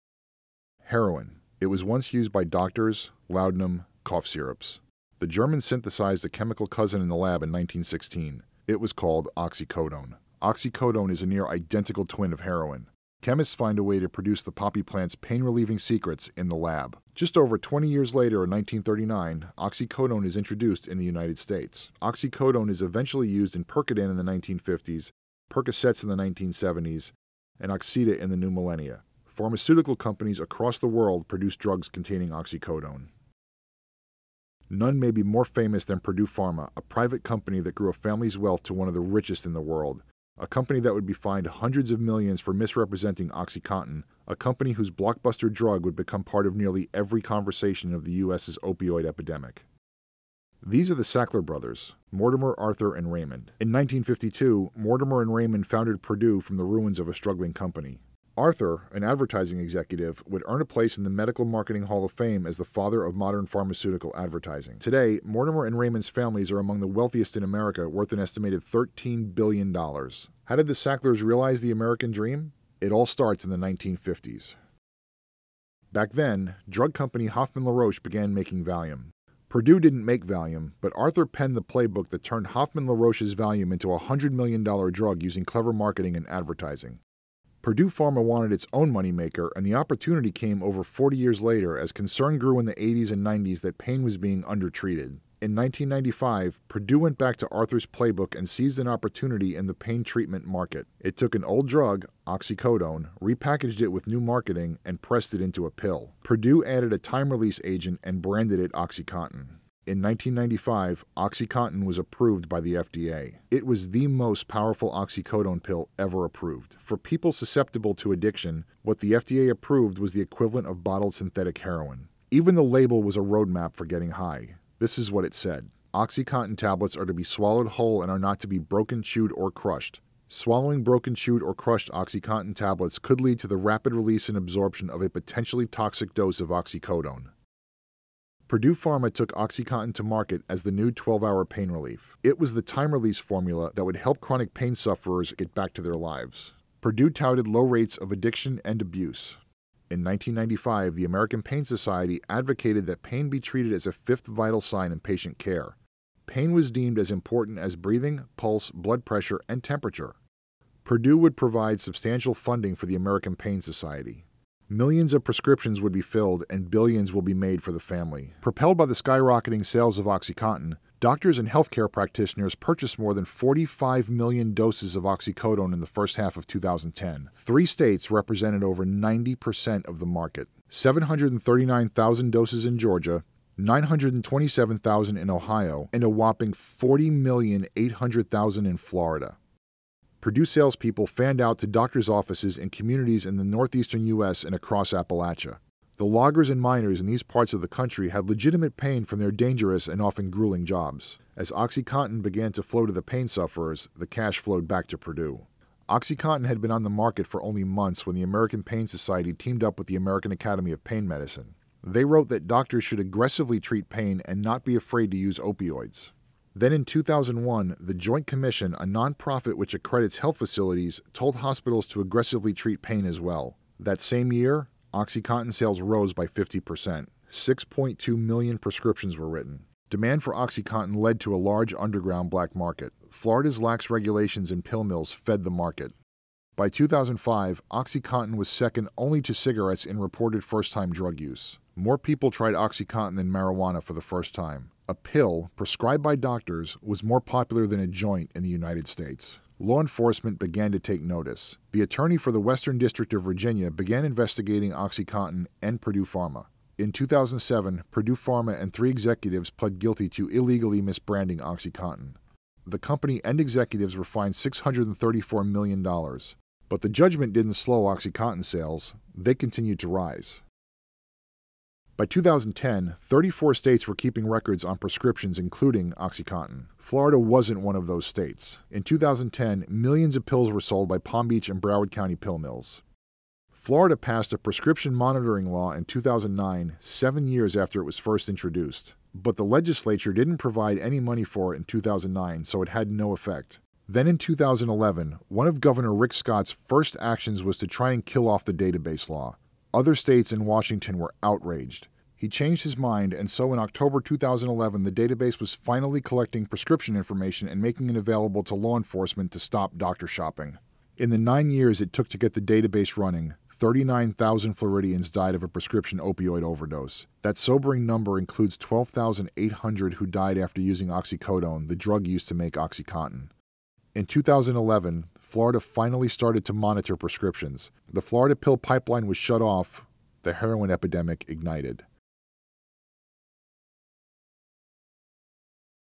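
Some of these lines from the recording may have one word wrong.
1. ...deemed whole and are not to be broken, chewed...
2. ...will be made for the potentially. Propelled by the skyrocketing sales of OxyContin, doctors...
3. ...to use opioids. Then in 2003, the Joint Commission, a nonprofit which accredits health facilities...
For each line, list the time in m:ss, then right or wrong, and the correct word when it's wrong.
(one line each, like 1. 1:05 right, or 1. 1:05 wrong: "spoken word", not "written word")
1. 2:07 wrong: "swallowed", not "deemed"
2. 2:47 wrong: "family", not "potentially"
3. 3:35 wrong: "2001", not "2003".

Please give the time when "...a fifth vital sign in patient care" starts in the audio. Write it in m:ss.
2:33.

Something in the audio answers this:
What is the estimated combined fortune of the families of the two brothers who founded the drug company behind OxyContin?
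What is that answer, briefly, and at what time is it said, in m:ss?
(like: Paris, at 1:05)
$13 billion, at 1:08.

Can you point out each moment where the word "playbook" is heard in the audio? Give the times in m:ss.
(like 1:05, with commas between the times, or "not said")
1:21, 1:37.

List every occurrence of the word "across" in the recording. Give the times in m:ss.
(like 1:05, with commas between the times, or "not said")
0:30, 3:14.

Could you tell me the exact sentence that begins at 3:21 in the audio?
As OxyContin began to flow to the pain sufferers, the cash flowed back to Purdue.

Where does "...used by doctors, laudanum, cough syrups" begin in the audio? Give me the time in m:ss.
0:02.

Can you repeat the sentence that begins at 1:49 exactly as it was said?
In 1995, OxyContin was approved by the FDA.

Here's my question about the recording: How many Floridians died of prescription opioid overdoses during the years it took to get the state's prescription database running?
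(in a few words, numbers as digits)
39,000.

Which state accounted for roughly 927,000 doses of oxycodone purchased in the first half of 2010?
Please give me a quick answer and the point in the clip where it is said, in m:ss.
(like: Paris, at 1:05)
Ohio, at 3:05.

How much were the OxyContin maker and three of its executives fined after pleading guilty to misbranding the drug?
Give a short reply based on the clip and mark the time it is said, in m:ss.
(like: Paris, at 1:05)
$634 million, at 4:24.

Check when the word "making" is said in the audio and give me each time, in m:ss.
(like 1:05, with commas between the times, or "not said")
1:18, 5:07.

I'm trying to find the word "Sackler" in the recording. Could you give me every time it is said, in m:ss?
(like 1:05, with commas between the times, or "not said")
0:51, 1:10.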